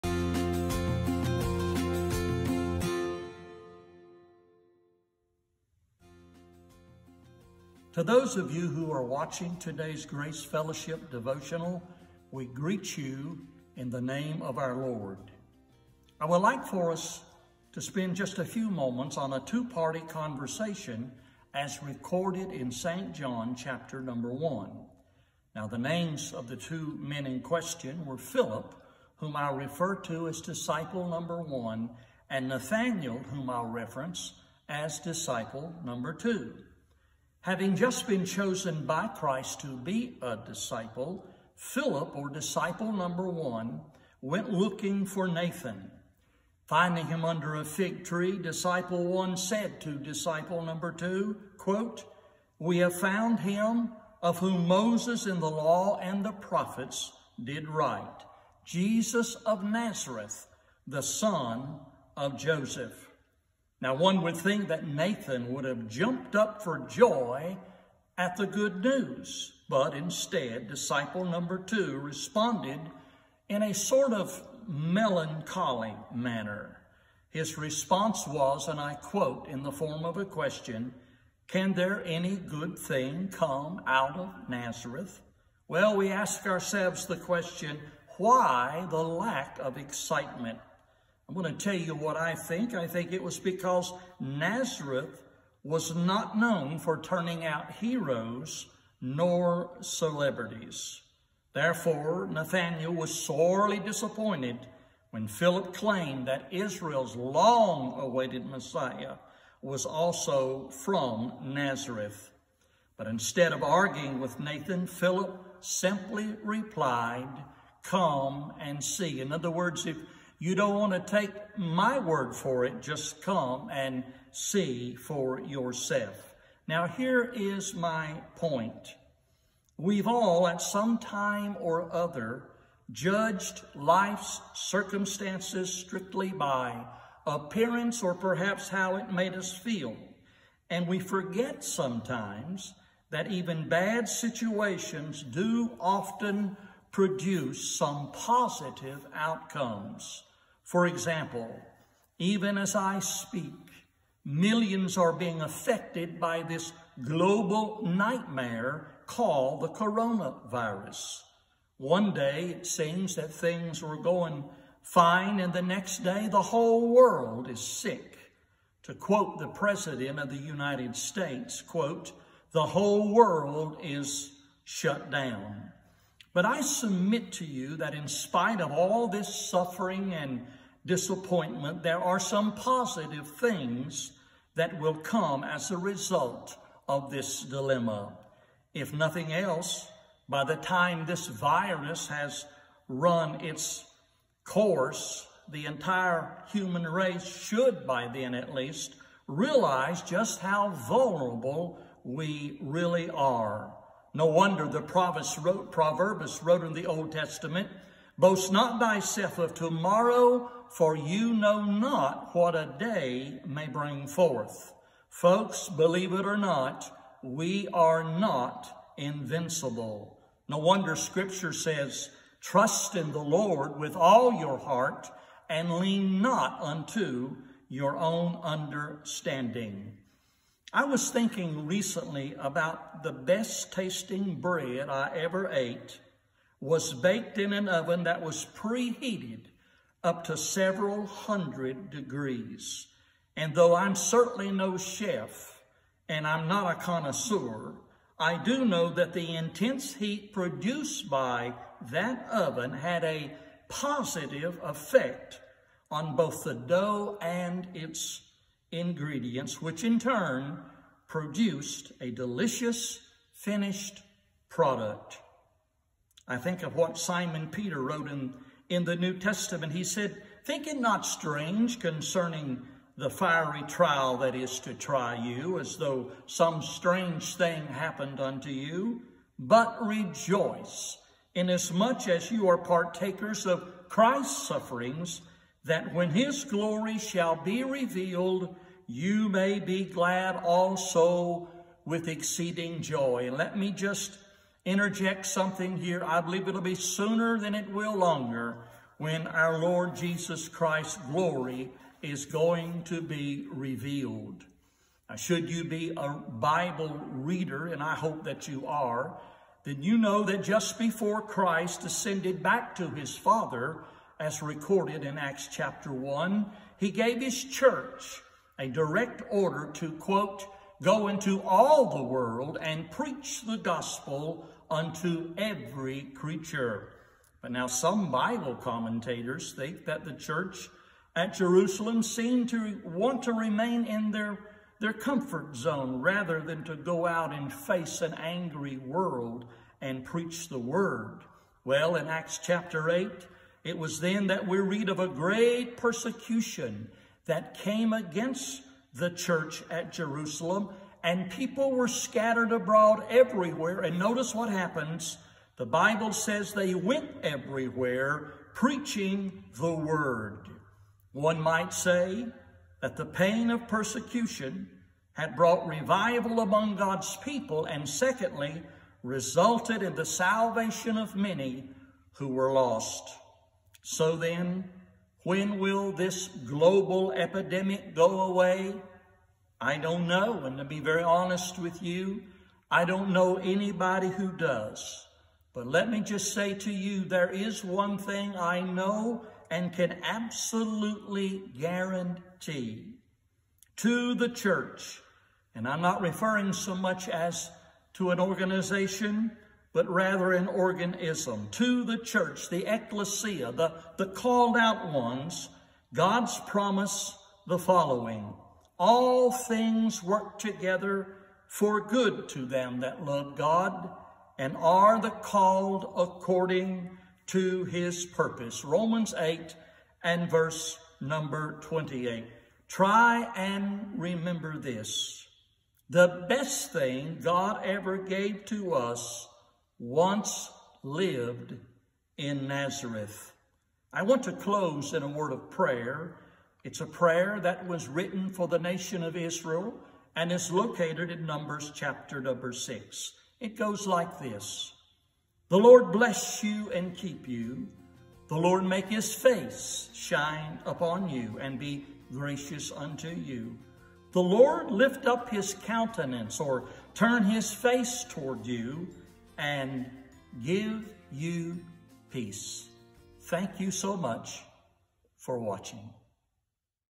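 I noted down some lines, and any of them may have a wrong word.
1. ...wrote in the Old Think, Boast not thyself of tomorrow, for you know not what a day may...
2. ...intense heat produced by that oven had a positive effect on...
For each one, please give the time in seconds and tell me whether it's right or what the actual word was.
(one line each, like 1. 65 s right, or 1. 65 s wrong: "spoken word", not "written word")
1. 206 s wrong: "Testament", not "Think"
2. 249 s right.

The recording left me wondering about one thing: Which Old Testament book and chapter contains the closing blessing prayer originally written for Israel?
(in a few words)
Numbers chapter 6.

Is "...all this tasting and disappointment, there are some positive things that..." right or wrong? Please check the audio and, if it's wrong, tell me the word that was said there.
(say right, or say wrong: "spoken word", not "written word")
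wrong: "suffering", not "tasting".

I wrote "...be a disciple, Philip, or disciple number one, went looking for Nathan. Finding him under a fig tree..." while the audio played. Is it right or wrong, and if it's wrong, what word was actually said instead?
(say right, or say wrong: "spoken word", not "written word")
right.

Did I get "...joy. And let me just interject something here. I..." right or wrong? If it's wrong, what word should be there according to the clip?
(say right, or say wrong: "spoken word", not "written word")
right.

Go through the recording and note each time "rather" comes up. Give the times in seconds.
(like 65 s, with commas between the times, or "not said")
336 s, 399 s.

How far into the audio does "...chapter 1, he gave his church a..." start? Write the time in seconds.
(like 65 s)
315 s.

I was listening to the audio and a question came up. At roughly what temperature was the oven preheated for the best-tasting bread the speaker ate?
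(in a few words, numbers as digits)
several hundred degrees.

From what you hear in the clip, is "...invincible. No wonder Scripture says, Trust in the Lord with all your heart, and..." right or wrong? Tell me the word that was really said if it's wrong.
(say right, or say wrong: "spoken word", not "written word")
right.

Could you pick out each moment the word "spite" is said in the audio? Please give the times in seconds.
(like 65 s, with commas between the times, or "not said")
178 s.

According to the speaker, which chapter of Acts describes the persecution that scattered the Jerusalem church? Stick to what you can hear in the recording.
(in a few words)
Acts chapter 8.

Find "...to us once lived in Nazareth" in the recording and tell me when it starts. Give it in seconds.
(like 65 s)
428 s.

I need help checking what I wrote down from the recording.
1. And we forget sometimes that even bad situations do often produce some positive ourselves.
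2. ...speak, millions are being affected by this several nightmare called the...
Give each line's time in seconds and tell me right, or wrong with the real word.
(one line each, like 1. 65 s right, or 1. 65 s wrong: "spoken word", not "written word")
1. 140 s wrong: "outcomes", not "ourselves"
2. 152 s wrong: "global", not "several".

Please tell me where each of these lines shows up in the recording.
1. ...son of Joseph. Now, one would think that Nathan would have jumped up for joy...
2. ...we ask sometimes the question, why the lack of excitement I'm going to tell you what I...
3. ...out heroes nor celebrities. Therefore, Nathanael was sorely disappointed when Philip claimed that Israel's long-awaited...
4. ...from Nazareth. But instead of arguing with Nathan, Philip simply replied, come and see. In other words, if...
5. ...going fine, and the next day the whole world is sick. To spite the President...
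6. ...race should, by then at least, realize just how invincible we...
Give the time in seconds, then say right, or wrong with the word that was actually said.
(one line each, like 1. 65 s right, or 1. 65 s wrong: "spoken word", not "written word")
1. 61 s right
2. 85 s wrong: "ourselves", not "sometimes"
3. 97 s right
4. 110 s right
5. 163 s wrong: "quote", not "spite"
6. 196 s wrong: "vulnerable", not "invincible".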